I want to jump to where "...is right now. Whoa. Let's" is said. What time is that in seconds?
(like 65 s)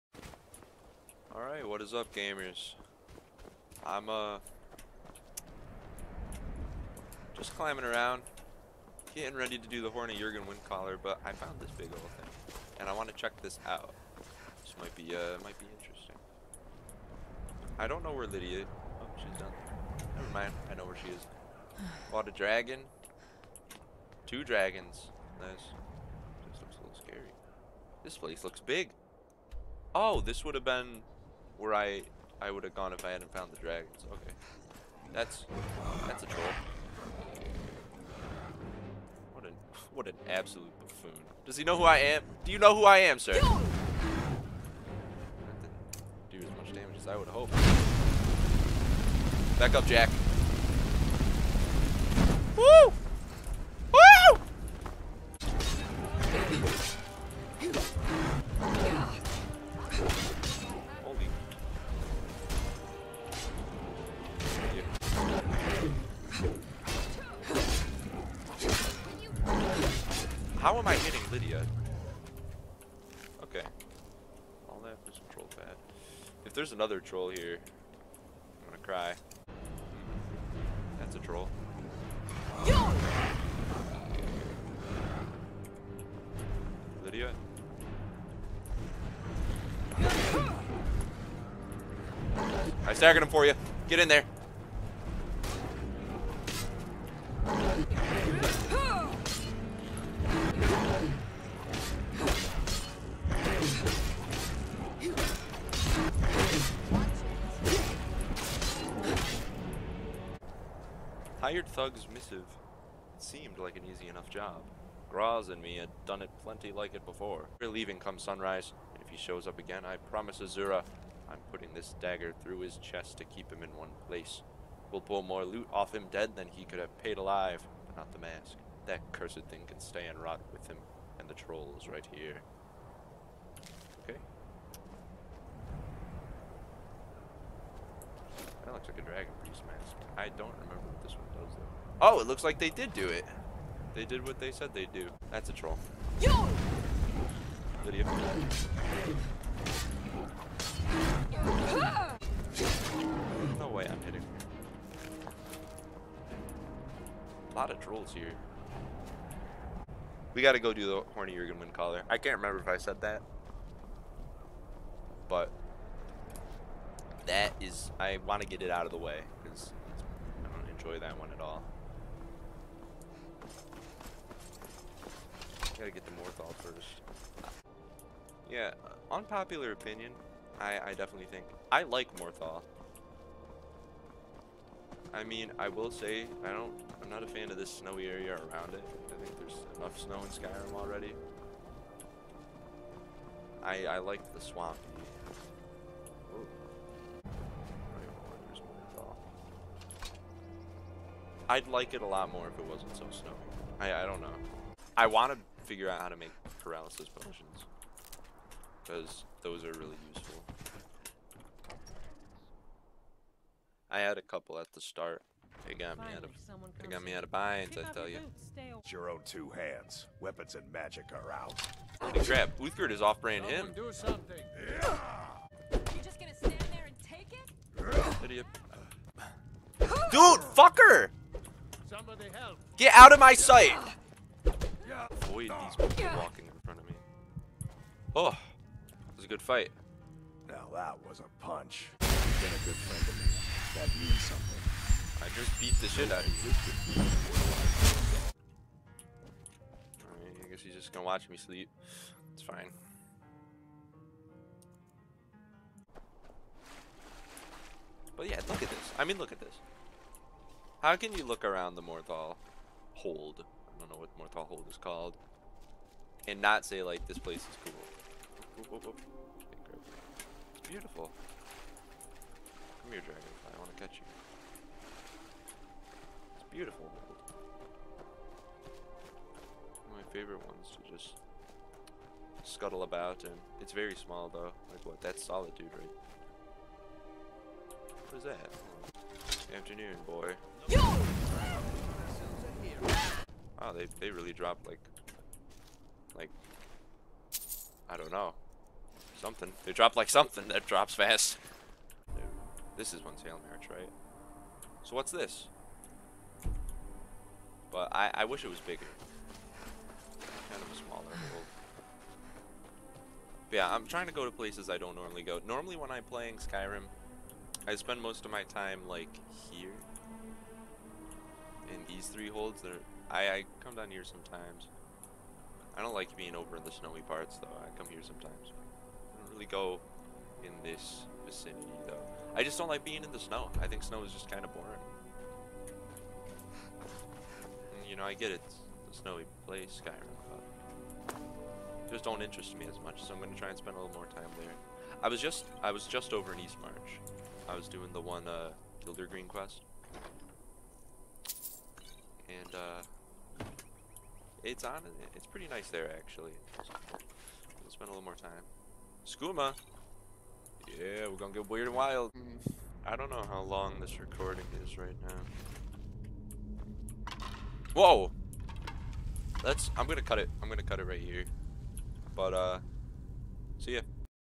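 364 s.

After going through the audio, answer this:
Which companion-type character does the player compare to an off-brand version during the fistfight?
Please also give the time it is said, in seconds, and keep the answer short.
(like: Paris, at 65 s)
Uthgerd, at 222 s.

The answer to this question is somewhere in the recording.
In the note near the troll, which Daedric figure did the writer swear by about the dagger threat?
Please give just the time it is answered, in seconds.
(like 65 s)
120 s.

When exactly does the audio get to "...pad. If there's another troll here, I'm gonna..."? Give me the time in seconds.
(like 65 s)
75 s.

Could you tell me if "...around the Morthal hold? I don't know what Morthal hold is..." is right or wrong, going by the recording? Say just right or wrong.
right.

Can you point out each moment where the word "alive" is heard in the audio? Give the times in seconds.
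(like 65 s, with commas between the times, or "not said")
127 s.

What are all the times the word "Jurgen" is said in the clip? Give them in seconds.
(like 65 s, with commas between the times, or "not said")
10 s, 161 s.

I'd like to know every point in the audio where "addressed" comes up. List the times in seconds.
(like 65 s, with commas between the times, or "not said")
not said.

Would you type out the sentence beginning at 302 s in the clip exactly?
this is one tail March, right?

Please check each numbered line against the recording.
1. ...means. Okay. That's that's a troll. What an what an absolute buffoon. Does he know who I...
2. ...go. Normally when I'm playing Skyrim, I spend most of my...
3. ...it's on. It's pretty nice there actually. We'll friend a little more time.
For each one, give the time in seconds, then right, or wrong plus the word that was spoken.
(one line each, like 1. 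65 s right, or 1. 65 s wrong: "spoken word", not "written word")
1. 33 s wrong: "dragons", not "means"
2. 315 s right
3. 354 s wrong: "spend", not "friend".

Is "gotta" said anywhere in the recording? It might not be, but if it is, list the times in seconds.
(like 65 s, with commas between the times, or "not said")
160 s, 175 s.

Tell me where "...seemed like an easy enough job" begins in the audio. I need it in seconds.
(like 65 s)
113 s.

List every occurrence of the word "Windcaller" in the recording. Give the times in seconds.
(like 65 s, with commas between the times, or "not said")
10 s, 161 s.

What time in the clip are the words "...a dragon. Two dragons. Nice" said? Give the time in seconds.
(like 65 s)
22 s.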